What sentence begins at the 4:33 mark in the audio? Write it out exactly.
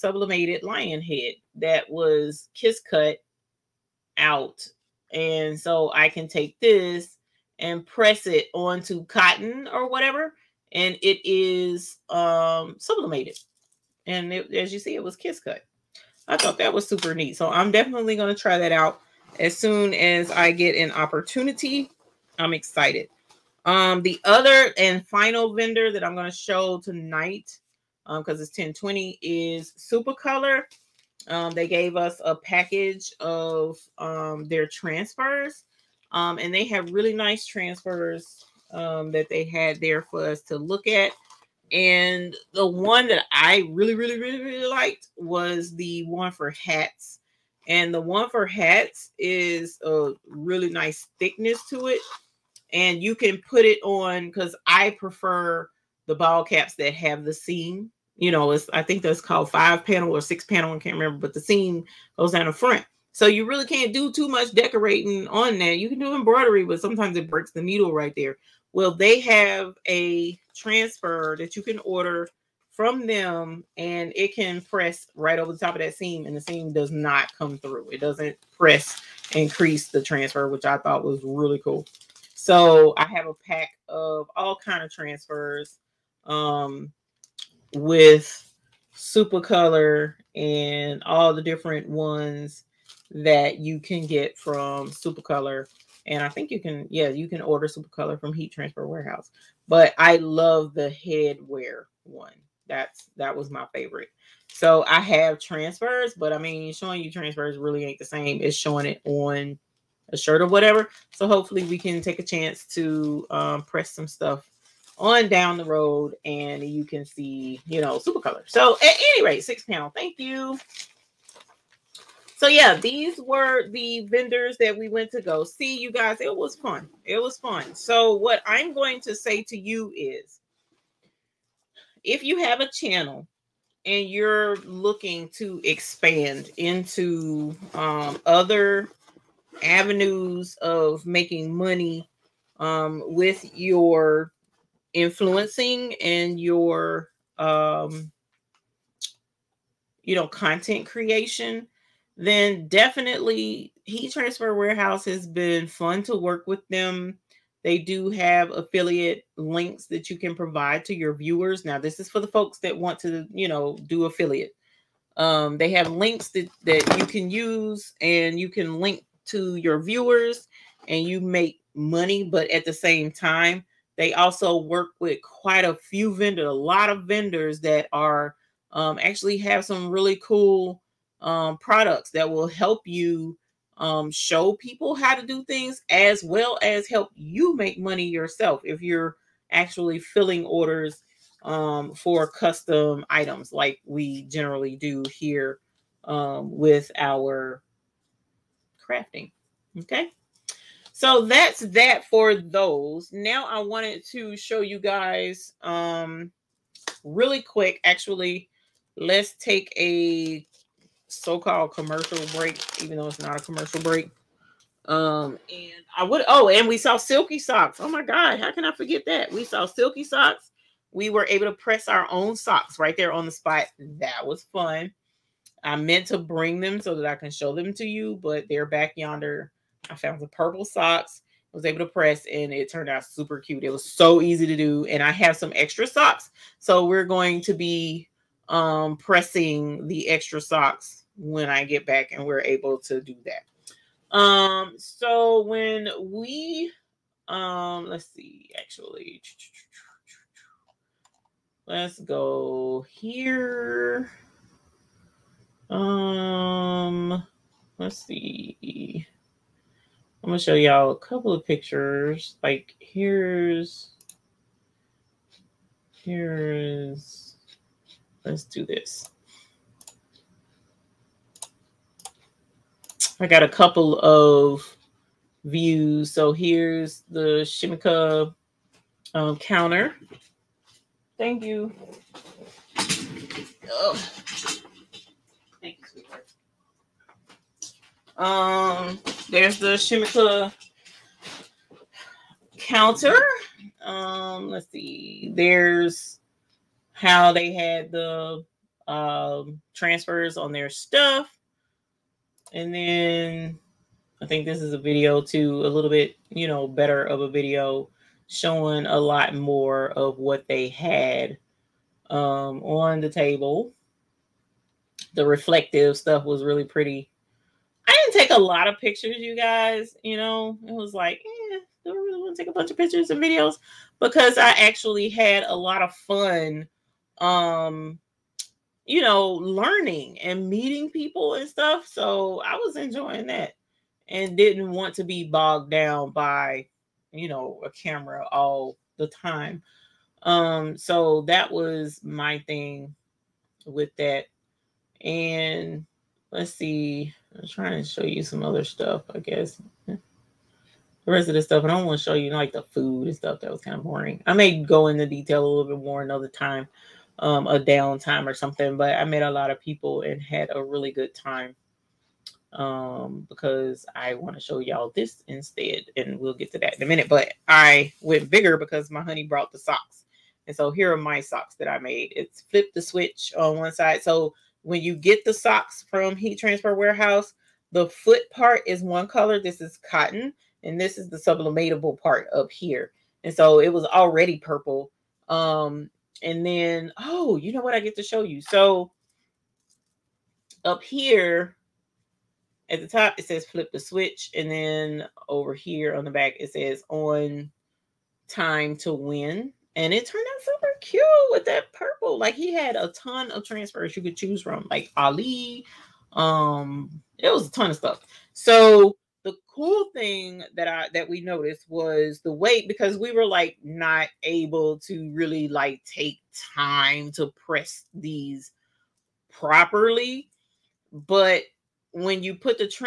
I got a couple of views.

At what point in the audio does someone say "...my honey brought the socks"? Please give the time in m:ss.
6:08.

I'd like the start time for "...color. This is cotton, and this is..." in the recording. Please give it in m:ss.
6:19.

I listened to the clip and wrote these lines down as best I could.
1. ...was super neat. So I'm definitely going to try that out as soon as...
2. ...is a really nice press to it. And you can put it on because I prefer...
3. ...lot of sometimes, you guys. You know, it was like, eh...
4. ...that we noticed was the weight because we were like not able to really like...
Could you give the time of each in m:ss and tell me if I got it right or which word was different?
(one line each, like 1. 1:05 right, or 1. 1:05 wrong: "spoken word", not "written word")
1. 0:16 right
2. 0:49 wrong: "thickness", not "press"
3. 5:18 wrong: "pictures", not "sometimes"
4. 6:50 right.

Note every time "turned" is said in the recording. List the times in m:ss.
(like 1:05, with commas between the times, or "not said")
3:52, 6:40.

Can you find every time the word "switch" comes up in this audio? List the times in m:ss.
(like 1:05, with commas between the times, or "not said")
6:12, 6:33.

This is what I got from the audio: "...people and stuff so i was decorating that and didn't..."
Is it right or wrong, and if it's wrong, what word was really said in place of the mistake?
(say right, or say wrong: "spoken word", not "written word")
wrong: "enjoying", not "decorating".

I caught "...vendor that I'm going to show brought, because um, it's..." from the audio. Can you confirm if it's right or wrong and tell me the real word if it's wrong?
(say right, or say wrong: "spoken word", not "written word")
wrong: "tonight", not "brought".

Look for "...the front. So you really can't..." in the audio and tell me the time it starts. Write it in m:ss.
1:02.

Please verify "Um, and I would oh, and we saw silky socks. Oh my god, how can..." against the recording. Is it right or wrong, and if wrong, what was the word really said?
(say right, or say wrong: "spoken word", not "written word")
right.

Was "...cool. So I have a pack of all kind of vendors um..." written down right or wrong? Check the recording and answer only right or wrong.
wrong.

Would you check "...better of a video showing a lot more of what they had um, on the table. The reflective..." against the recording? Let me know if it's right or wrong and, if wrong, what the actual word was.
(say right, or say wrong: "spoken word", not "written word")
right.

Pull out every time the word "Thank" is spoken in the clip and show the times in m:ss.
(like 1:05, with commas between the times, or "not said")
1:59, 4:41, 4:45.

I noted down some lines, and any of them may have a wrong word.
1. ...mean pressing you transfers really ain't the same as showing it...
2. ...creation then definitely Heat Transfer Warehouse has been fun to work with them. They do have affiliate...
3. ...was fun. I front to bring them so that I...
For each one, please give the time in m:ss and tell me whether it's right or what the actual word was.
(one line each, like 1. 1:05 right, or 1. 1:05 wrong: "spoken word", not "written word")
1. 1:46 wrong: "showing", not "pressing"
2. 2:30 right
3. 3:44 wrong: "meant", not "front".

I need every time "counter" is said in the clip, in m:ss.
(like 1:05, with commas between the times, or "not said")
4:39, 4:52.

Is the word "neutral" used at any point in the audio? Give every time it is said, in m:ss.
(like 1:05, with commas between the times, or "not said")
not said.